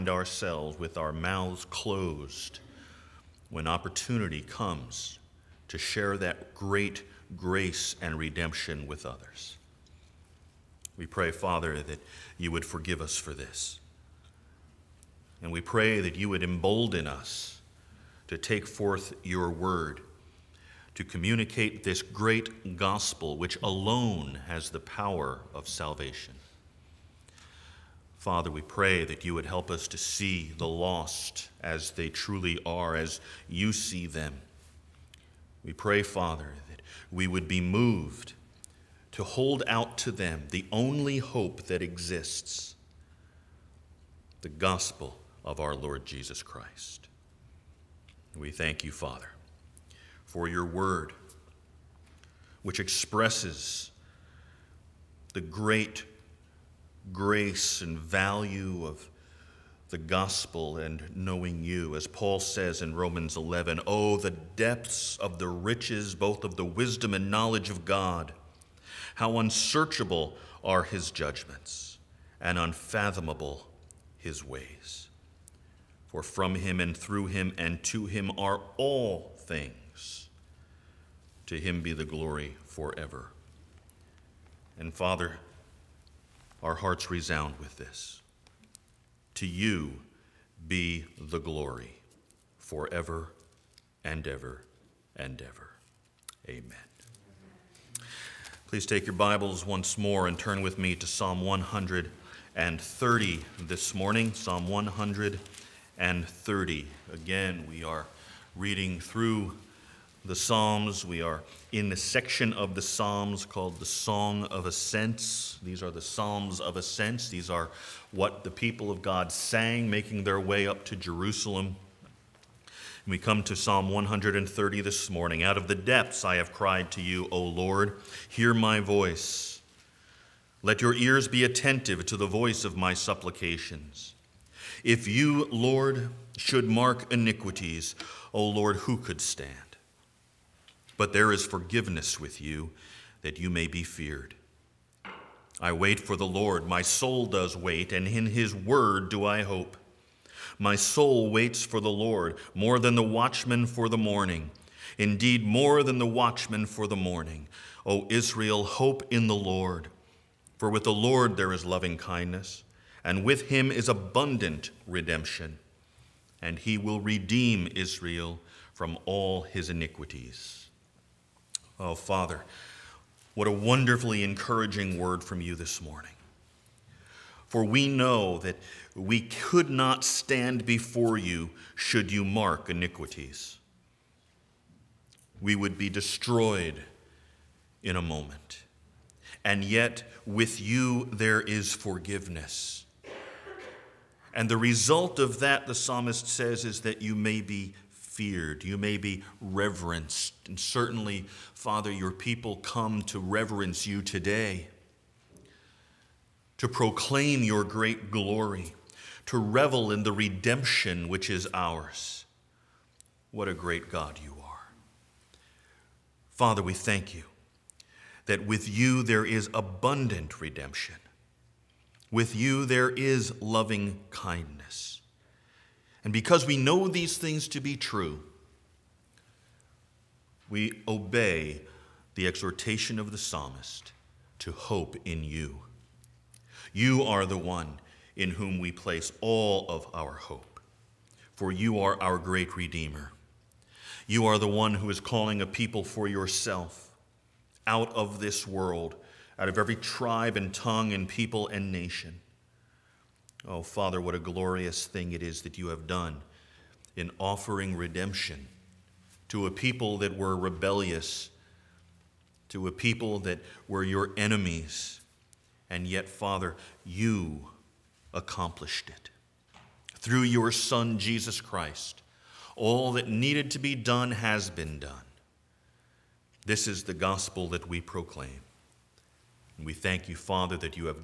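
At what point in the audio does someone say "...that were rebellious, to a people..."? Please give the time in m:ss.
4:19.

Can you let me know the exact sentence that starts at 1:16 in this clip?
For from him and through him and to him are all things.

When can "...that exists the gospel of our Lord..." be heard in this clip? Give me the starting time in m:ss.
0:41.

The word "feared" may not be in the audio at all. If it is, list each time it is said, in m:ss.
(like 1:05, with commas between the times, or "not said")
2:23, 3:17.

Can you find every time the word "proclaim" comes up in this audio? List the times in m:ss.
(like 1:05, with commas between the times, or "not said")
3:26, 4:37.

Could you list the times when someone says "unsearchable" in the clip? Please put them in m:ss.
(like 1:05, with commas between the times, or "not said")
1:09.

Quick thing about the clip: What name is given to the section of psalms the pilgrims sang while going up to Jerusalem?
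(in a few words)
Song of Ascents.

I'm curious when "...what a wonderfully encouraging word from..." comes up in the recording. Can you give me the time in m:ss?
2:53.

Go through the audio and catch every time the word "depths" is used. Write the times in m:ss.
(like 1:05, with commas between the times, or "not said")
1:04, 2:05.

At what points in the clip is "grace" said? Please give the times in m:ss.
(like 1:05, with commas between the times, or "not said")
0:07, 0:57.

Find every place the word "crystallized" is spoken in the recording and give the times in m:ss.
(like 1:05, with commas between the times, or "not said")
not said.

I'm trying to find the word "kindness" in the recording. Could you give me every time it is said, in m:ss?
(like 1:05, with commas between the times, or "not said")
2:41, 3:44.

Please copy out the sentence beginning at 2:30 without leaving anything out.
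My soul waits for the Lord more than the watchman for the morning.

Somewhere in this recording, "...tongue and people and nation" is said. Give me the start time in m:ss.
4:10.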